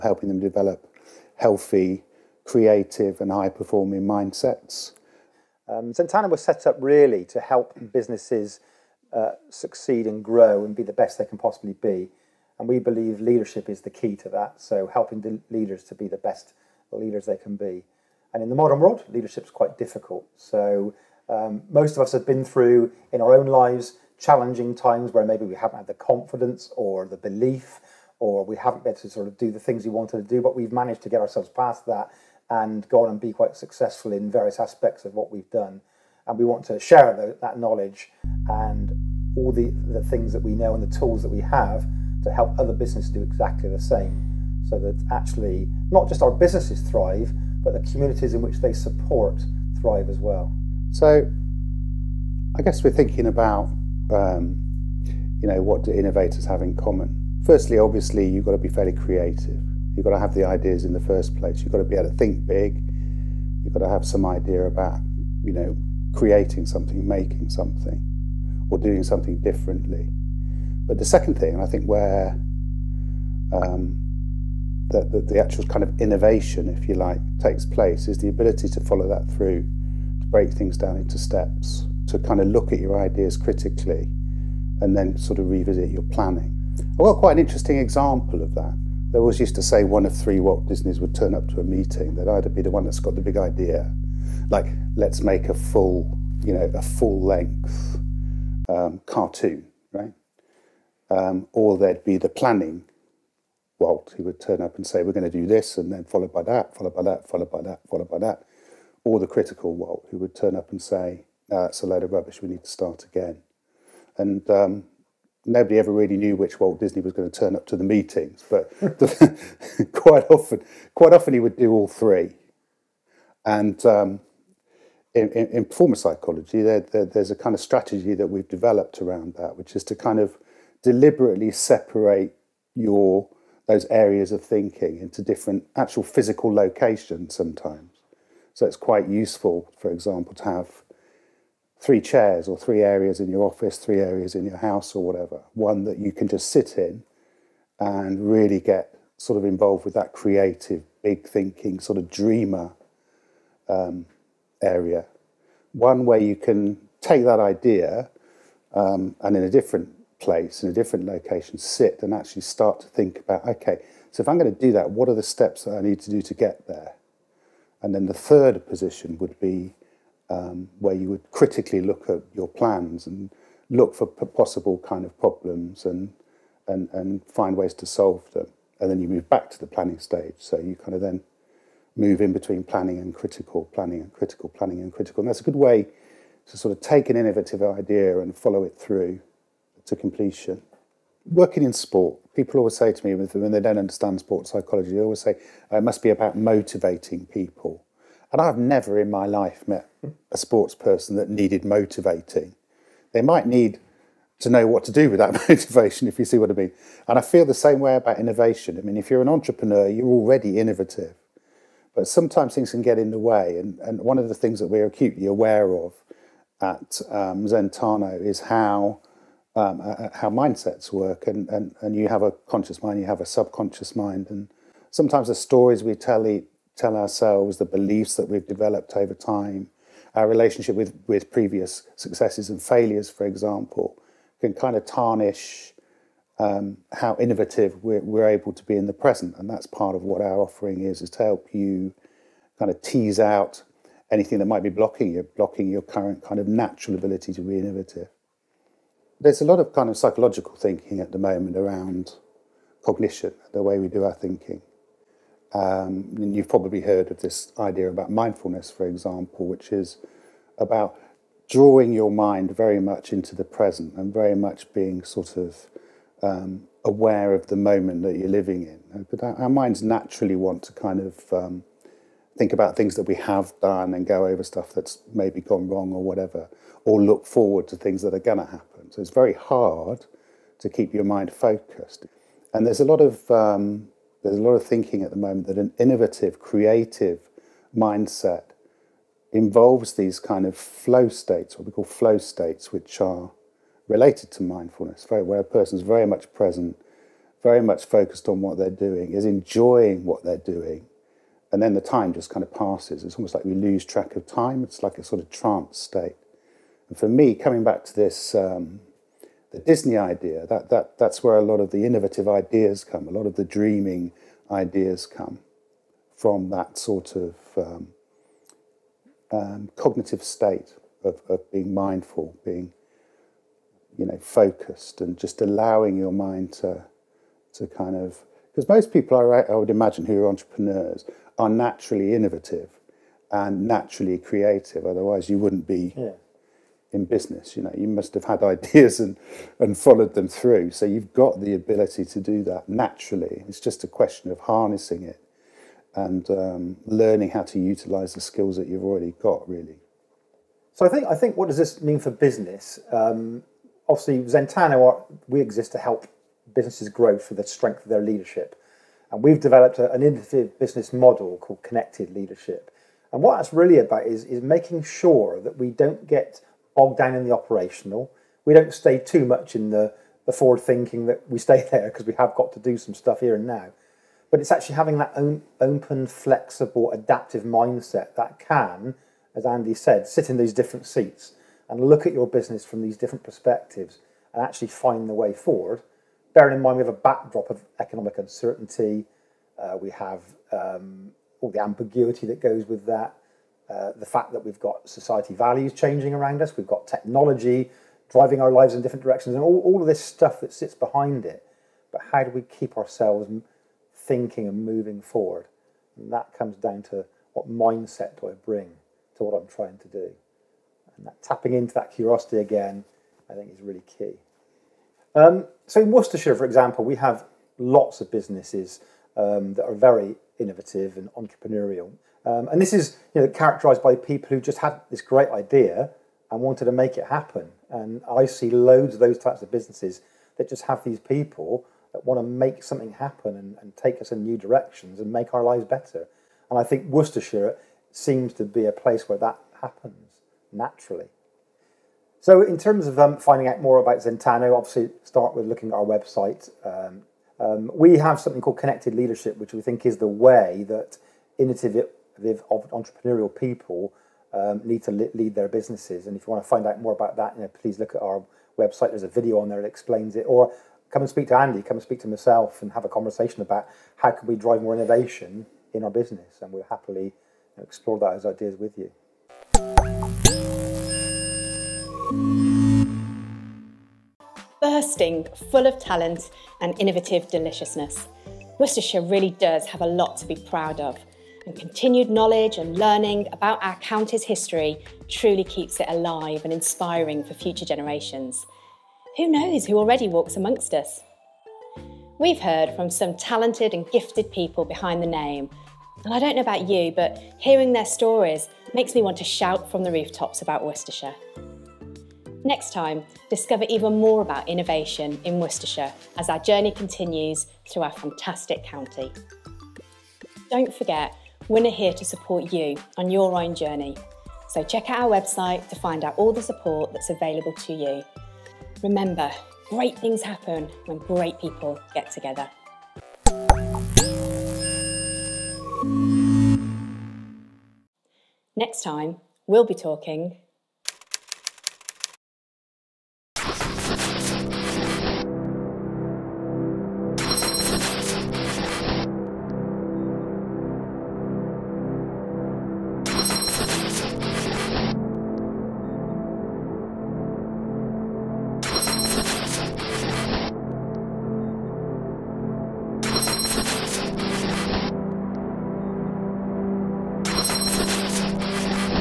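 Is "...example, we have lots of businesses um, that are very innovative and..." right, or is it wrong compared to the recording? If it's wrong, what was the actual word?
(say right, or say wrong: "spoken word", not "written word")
right.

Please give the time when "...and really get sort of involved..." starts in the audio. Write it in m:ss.
2:27.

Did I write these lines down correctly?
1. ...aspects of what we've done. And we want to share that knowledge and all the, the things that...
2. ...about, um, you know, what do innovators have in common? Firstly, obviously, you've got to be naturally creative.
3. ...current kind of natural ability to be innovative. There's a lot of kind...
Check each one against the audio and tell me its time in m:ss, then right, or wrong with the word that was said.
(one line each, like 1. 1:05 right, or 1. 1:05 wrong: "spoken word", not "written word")
1. 0:34 right
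2. 0:53 wrong: "fairly", not "naturally"
3. 4:05 right.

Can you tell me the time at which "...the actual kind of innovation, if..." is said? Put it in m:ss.
1:15.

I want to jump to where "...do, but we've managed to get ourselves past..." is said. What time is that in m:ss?
0:30.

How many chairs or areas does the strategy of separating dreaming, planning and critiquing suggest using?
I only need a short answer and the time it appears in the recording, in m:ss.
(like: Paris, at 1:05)
3, at 2:21.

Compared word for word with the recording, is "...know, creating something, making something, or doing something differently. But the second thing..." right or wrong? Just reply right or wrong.
right.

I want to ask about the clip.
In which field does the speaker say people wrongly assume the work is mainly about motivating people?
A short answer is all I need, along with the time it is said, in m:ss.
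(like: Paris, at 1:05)
sport psychology, at 3:14.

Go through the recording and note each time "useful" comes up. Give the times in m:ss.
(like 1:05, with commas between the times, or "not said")
2:19.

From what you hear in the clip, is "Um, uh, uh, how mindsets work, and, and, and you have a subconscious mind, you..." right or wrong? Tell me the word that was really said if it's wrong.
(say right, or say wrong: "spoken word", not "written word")
wrong: "conscious", not "subconscious".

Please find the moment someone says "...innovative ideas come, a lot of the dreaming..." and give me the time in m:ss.
5:11.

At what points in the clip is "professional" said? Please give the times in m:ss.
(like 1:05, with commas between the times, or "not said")
not said.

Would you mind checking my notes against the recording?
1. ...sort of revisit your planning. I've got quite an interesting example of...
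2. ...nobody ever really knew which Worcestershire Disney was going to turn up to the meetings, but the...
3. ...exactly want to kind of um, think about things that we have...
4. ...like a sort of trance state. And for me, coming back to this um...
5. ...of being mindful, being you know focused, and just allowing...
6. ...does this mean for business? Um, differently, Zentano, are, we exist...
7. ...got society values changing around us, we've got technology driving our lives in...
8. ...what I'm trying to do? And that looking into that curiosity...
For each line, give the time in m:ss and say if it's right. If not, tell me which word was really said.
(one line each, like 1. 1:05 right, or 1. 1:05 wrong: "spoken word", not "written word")
1. 1:25 right
2. 1:55 wrong: "Walt", not "Worcestershire"
3. 4:29 wrong: "naturally", not "exactly"
4. 5:04 right
5. 5:21 right
6. 5:51 wrong: "obviously", not "differently"
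7. 6:34 right
8. 6:49 wrong: "tapping", not "looking".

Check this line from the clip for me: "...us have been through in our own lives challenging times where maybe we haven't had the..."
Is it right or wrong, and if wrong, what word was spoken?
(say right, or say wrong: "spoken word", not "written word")
right.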